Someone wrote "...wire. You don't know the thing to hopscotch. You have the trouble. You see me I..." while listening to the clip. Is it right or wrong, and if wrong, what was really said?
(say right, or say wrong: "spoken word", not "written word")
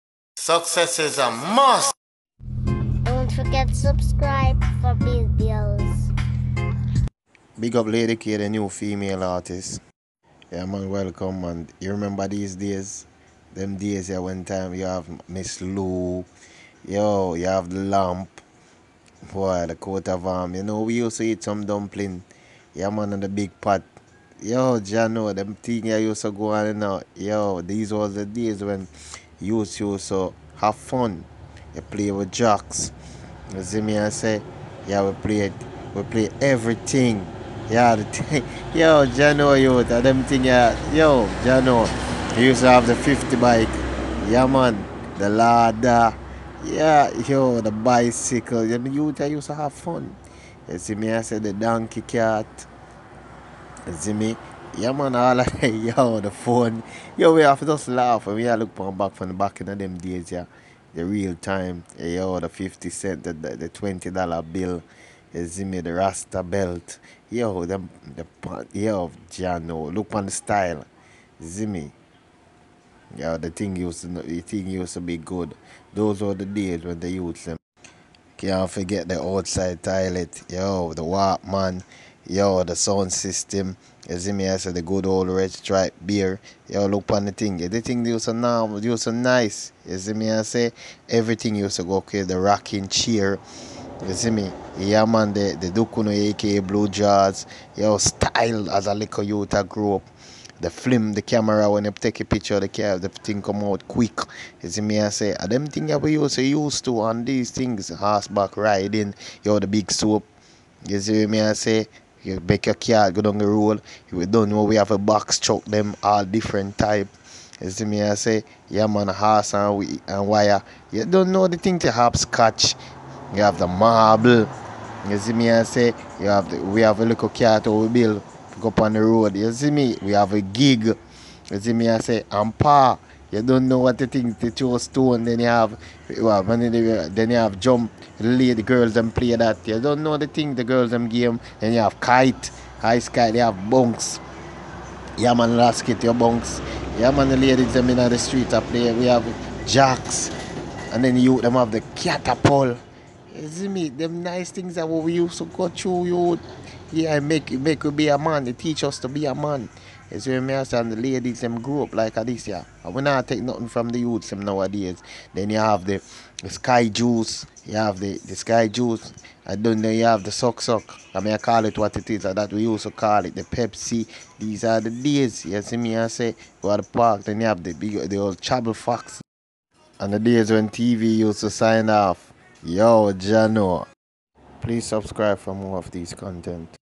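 wrong: "marble", not "trouble".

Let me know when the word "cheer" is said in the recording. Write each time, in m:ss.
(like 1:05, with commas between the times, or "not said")
1:32.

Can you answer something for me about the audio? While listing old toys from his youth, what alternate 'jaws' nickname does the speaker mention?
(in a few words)
Blue Jaws.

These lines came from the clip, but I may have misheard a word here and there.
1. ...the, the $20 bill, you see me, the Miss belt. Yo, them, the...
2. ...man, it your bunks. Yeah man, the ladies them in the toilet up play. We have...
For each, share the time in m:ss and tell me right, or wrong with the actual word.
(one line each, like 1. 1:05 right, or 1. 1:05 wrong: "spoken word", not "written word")
1. 1:03 wrong: "Rasta", not "Miss"
2. 2:25 wrong: "street", not "toilet".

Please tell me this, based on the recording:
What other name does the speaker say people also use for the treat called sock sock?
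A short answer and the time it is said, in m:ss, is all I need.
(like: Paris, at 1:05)
Pepsi, at 2:53.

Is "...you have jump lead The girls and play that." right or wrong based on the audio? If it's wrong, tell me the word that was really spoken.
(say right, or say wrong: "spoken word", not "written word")
right.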